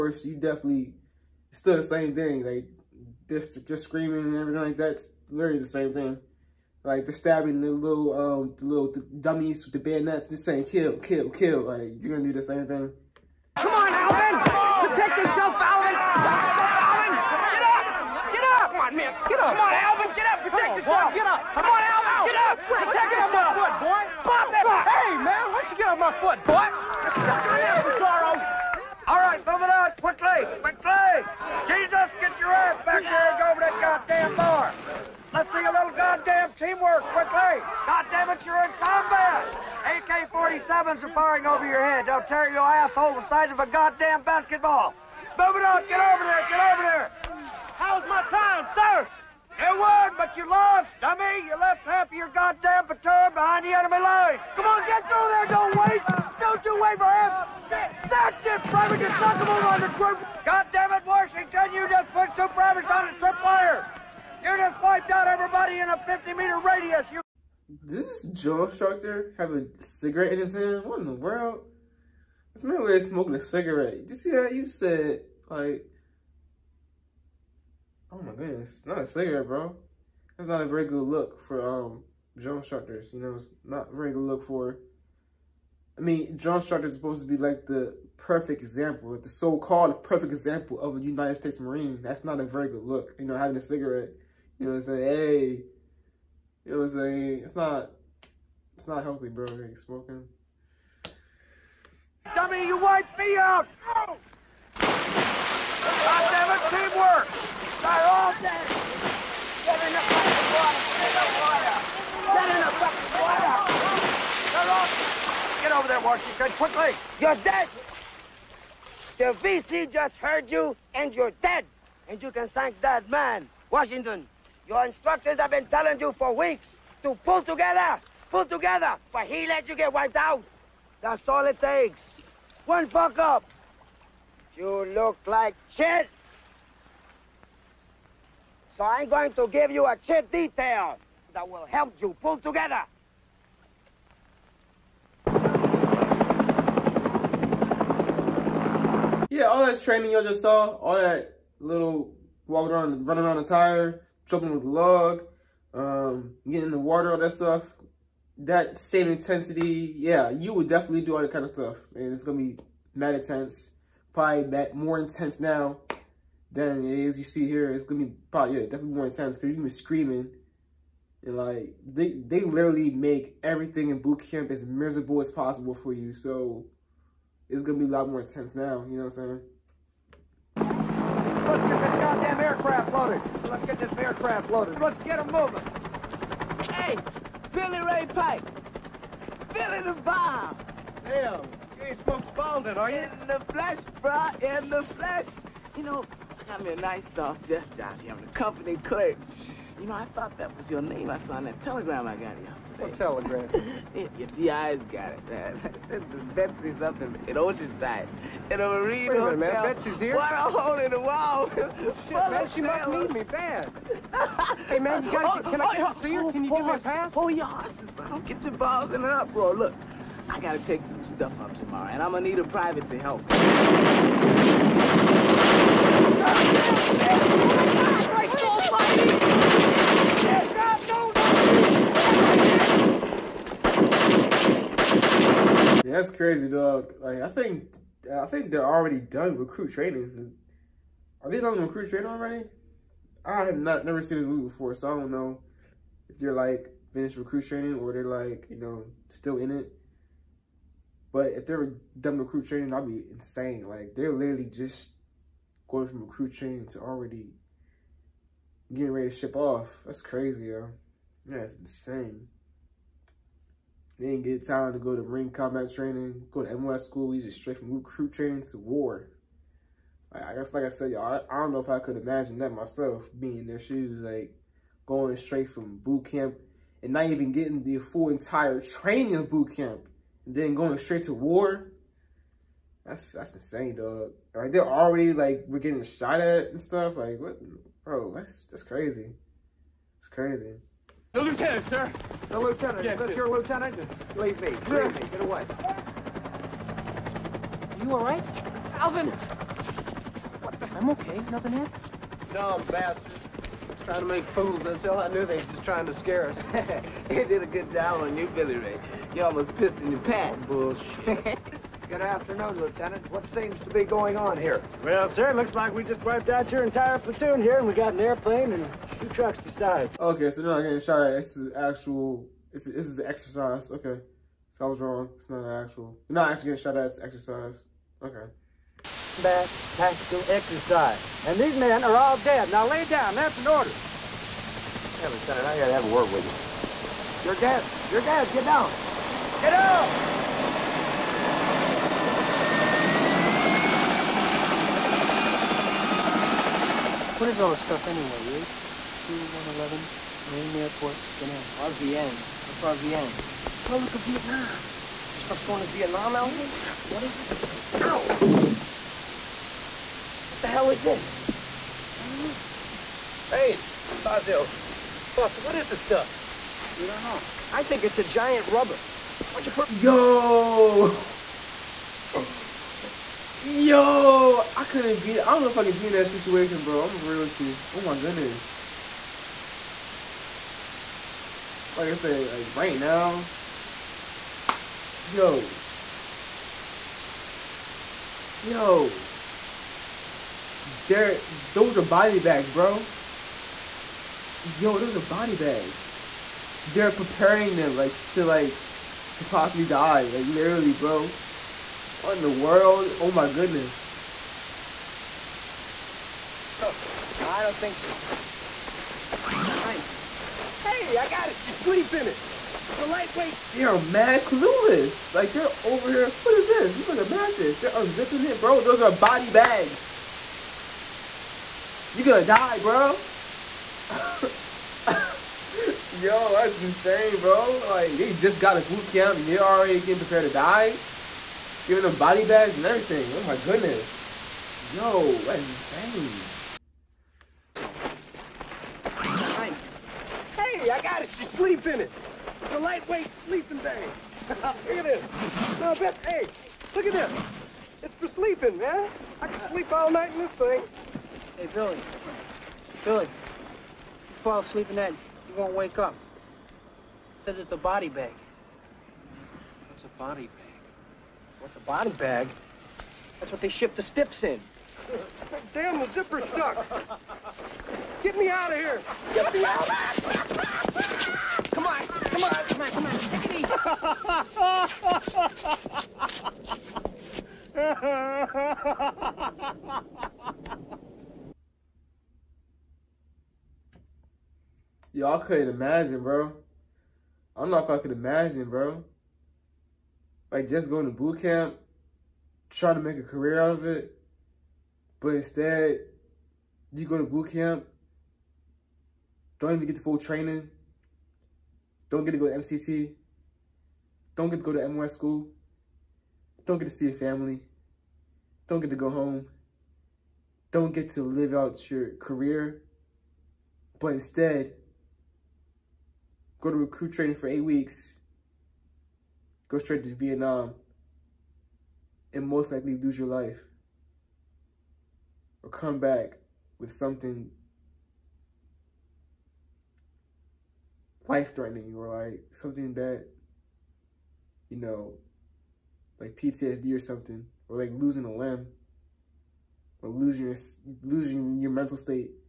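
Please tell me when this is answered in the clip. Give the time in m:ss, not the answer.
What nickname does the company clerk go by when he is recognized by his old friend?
3:12.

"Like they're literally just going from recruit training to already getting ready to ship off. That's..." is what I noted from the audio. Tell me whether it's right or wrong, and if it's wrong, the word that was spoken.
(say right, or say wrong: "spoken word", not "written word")
right.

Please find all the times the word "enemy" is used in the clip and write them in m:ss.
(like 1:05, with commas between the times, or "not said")
0:53.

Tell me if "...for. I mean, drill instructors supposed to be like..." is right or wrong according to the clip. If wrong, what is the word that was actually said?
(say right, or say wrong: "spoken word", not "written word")
right.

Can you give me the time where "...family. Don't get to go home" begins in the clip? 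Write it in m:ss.
8:26.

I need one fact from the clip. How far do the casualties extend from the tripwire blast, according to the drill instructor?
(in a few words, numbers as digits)
50-meter radius.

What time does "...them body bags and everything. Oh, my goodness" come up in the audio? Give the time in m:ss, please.
7:11.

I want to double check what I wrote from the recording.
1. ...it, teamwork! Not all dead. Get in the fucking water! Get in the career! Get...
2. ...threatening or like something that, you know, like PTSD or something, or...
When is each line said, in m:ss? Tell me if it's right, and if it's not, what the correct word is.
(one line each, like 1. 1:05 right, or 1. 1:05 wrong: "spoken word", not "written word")
1. 1:46 wrong: "water", not "career"
2. 8:51 right.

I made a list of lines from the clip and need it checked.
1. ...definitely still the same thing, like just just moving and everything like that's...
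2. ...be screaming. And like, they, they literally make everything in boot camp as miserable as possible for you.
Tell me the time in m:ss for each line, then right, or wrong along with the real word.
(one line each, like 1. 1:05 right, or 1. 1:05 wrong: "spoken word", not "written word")
1. 0:00 wrong: "screaming", not "moving"
2. 2:49 right.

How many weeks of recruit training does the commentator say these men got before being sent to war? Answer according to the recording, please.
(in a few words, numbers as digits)
8.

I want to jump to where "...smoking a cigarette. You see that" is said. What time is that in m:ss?
1:13.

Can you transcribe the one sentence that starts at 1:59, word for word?
The VC just heard you, and you're dead!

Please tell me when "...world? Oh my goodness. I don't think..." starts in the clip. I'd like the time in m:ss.
6:42.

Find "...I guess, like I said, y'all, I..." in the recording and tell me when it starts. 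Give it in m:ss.
4:30.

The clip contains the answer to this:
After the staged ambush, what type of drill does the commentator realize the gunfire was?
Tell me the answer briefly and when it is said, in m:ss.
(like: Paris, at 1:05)
Combat tactical exercise, at 5:29.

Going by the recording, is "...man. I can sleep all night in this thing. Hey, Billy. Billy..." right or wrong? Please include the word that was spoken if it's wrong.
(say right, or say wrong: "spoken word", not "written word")
right.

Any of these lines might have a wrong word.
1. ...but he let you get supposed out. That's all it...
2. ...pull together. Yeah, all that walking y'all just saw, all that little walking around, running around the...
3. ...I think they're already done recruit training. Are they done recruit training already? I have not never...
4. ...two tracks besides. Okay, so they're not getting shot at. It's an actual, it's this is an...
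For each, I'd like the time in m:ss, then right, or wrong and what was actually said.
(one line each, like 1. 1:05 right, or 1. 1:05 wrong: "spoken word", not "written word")
1. 2:09 wrong: "wiped", not "supposed"
2. 2:22 wrong: "training", not "walking"
3. 3:58 right
4. 5:18 right.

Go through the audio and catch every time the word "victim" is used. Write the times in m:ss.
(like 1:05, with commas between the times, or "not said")
not said.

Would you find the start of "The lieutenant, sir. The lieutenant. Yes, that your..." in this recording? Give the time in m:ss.
4:51.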